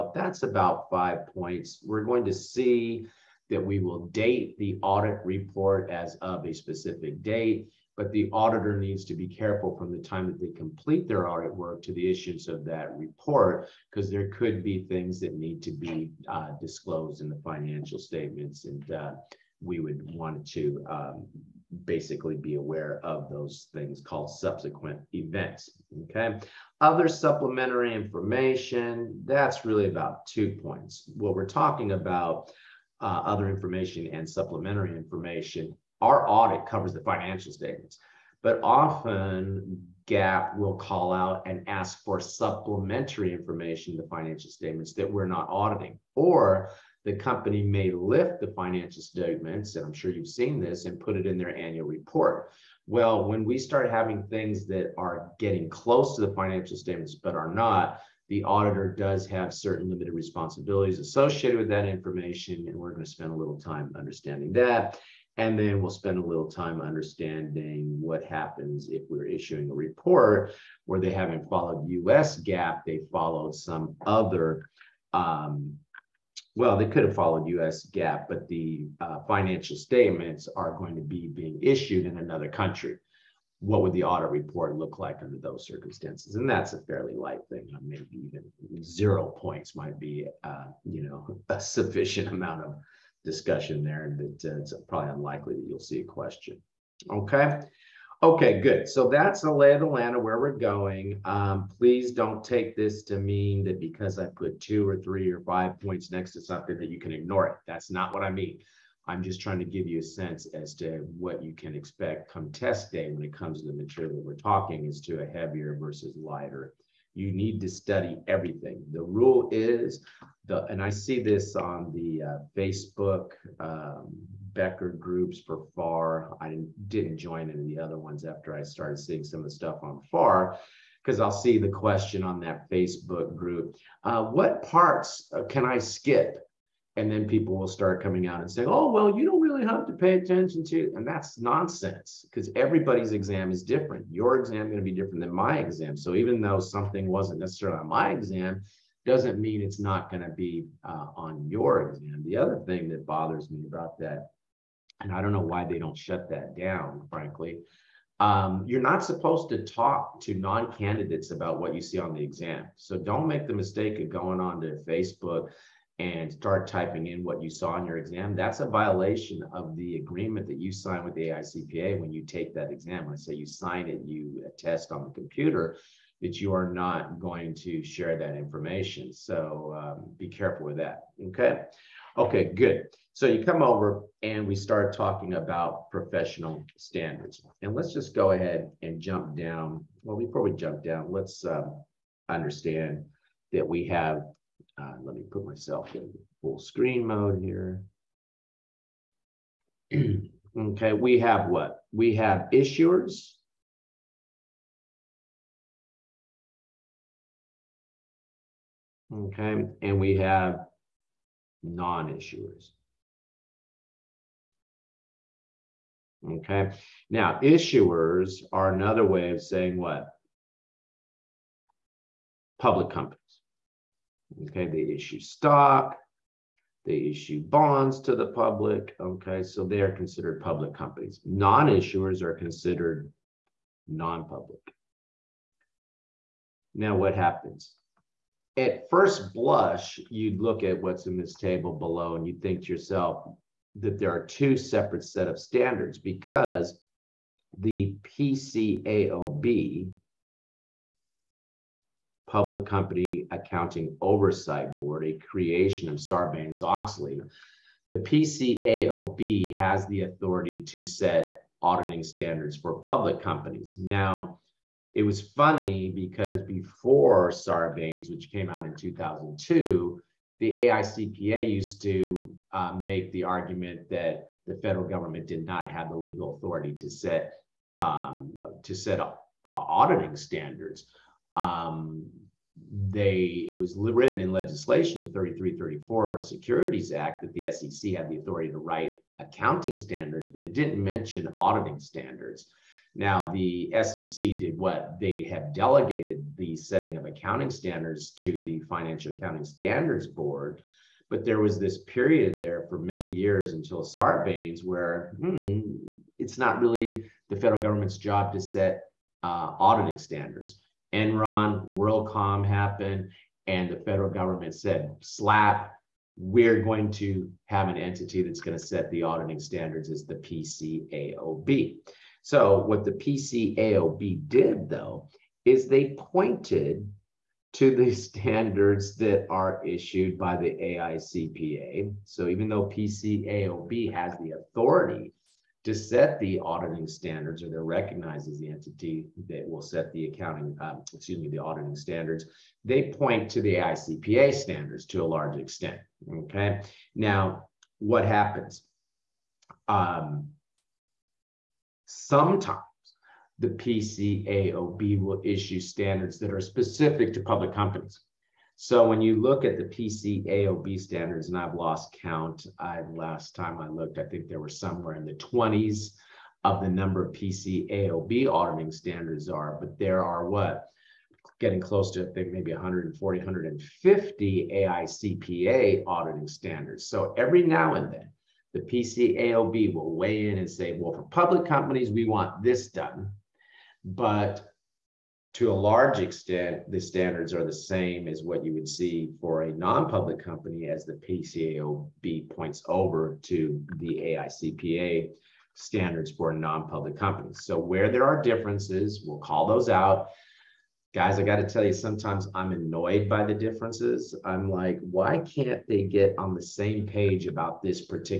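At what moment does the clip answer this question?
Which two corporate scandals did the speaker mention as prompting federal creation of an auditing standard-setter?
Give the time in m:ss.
5:10.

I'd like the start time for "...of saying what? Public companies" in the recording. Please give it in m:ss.
3:39.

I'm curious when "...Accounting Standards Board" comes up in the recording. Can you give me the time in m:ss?
4:59.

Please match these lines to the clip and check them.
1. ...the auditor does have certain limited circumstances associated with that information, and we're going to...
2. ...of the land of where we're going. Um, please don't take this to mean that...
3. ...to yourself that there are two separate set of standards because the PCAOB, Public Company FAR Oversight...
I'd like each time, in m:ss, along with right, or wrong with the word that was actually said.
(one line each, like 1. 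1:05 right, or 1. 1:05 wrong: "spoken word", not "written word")
1. 0:58 wrong: "responsibilities", not "circumstances"
2. 1:39 right
3. 4:02 wrong: "Accounting", not "FAR".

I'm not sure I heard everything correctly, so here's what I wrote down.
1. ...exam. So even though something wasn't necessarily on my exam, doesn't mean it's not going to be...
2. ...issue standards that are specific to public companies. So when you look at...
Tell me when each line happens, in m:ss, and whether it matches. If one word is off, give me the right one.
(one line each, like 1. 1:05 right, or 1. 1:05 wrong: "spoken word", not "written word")
1. 2:25 right
2. 5:55 right.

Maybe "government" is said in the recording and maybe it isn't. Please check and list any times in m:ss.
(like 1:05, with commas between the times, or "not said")
4:34, 5:07, 5:14.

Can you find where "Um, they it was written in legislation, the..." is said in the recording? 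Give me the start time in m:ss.
4:41.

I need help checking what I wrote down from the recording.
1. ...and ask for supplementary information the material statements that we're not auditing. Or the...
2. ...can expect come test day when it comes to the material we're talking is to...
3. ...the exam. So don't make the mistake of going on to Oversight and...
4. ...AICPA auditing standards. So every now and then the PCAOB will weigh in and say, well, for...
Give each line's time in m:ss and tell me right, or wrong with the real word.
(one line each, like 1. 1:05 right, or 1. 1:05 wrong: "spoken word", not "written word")
1. 0:41 wrong: "financial", not "material"
2. 1:51 right
3. 2:42 wrong: "Facebook", not "Oversight"
4. 6:14 right.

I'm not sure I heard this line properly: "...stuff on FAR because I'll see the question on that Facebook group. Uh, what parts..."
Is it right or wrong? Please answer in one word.
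right.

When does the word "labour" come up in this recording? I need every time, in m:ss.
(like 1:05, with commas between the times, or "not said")
not said.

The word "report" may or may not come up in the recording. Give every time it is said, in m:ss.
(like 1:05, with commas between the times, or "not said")
0:05, 0:12, 0:51, 1:09, 1:24.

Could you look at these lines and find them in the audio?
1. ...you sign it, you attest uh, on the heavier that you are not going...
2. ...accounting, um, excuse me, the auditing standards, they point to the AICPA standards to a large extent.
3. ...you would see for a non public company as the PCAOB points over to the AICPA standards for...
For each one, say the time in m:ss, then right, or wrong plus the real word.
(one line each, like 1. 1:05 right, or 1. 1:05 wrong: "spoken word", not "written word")
1. 2:53 wrong: "computer", not "heavier"
2. 5:40 right
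3. 6:28 right.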